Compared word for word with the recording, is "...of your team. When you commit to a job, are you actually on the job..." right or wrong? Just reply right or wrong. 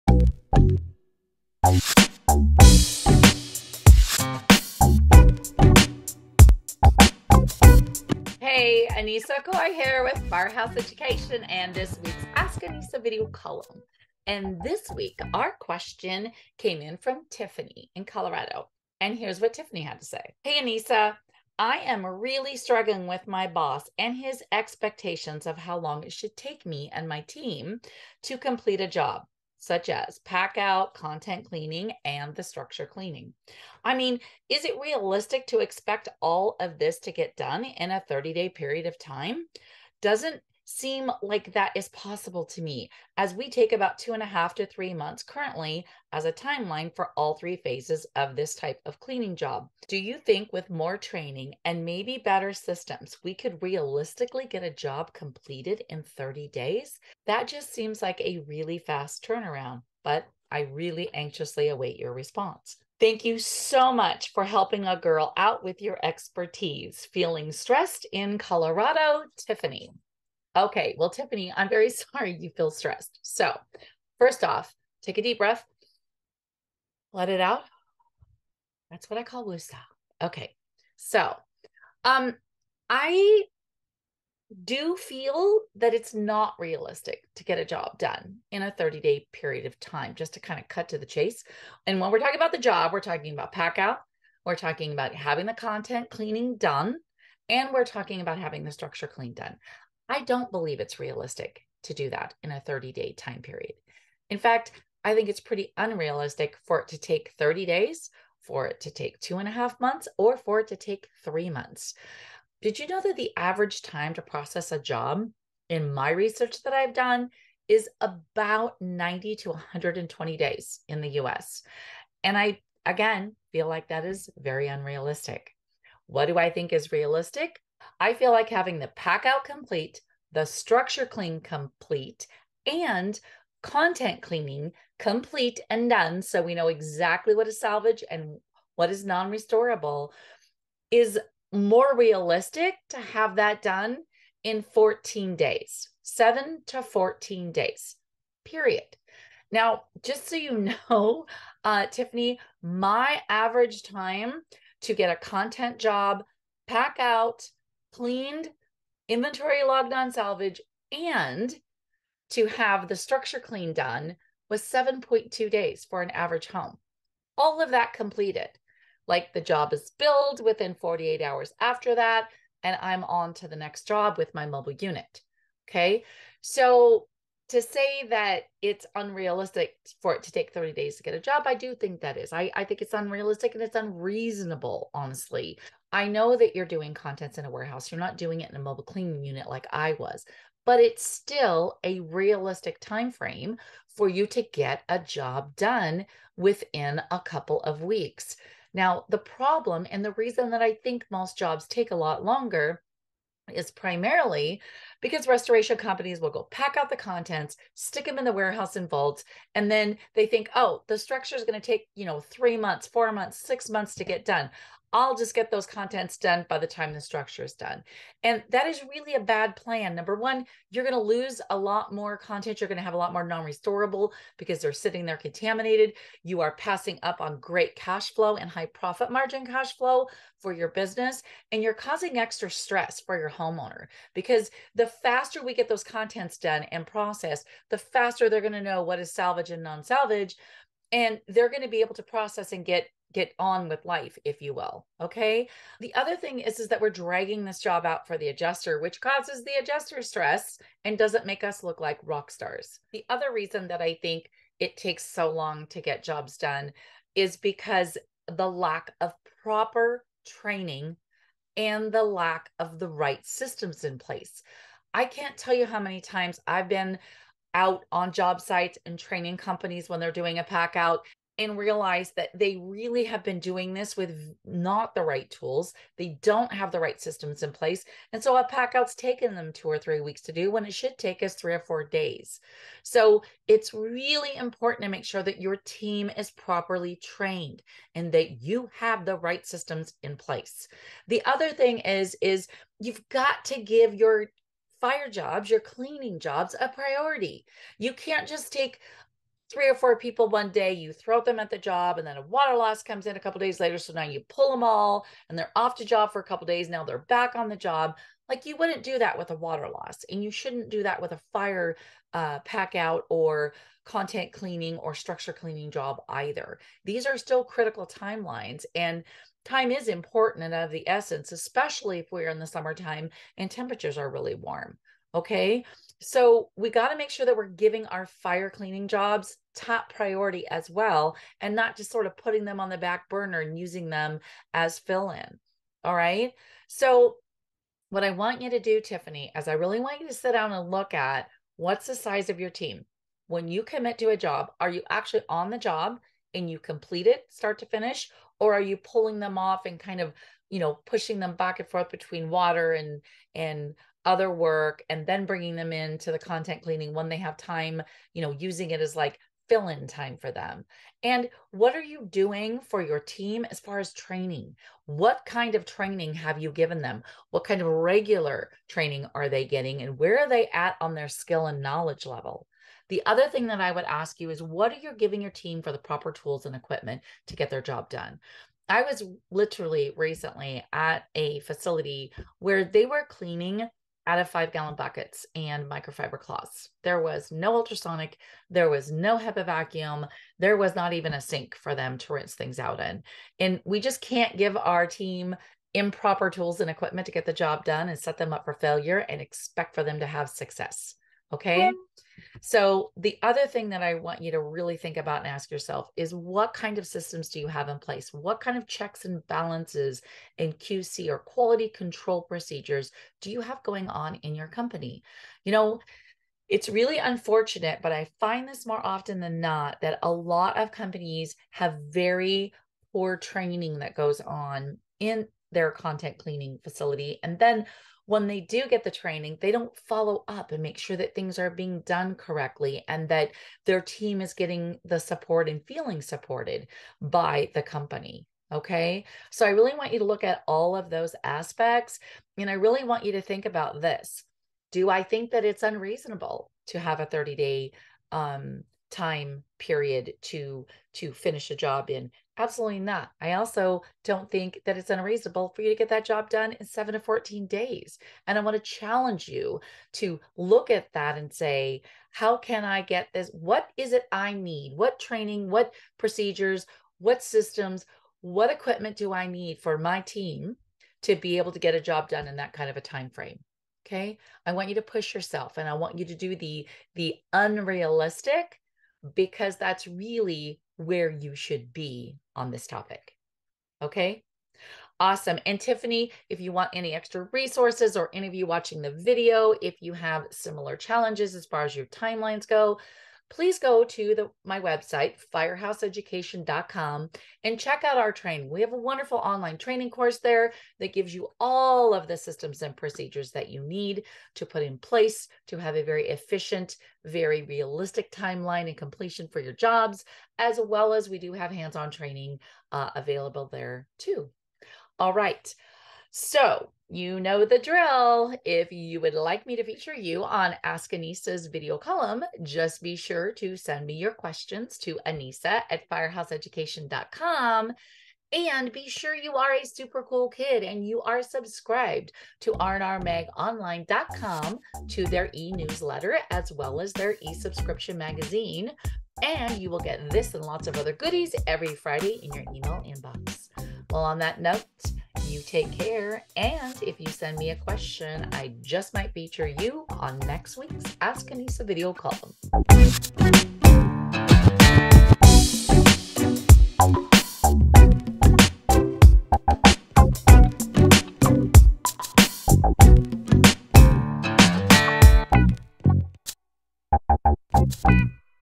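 right.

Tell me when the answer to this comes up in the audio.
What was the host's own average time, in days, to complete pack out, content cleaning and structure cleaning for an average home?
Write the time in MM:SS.
02:44.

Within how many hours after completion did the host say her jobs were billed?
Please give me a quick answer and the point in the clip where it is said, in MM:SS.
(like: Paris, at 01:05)
48 hours, at 02:50.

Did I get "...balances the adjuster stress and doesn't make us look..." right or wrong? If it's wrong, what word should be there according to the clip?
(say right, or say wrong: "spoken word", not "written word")
wrong: "causes", not "balances".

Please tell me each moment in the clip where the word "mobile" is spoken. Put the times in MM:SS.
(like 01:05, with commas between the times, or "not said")
02:54, 03:08.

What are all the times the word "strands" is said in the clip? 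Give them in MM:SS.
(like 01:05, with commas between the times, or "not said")
not said.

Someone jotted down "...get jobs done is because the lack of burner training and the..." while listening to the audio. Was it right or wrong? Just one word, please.
wrong.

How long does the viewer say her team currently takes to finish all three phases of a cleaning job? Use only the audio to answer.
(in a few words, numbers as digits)
2.5 to 3 months.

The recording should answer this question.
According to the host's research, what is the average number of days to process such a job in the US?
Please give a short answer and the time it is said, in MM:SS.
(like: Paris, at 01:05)
90 to 120 days, at 01:58.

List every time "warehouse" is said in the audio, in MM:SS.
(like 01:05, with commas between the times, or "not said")
03:07, 03:28.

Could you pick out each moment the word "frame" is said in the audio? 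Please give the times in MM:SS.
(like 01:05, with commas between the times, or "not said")
03:13, 07:53.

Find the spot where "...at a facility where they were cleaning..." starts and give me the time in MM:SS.
06:20.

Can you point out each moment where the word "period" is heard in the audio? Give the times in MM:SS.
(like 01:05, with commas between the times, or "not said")
00:38, 01:29, 01:43, 02:28, 07:29.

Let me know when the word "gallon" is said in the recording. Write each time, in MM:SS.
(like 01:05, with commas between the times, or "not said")
06:24.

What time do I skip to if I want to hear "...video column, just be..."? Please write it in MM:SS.
08:41.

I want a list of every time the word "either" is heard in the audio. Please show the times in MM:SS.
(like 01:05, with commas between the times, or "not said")
05:16.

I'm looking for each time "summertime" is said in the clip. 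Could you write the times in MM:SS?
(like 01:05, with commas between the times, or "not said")
05:22.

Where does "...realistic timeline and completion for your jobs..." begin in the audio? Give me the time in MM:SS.
08:27.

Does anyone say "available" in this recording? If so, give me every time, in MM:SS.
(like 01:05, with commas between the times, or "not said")
08:32.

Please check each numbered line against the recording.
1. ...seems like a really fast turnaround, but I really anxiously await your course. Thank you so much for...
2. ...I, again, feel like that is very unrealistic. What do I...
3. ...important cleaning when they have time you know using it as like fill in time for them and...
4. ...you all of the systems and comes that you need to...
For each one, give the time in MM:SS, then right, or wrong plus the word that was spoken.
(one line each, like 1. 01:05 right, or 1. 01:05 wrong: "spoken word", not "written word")
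1. 00:57 wrong: "response", not "course"
2. 02:02 right
3. 05:56 wrong: "content", not "important"
4. 08:21 wrong: "procedures", not "comes".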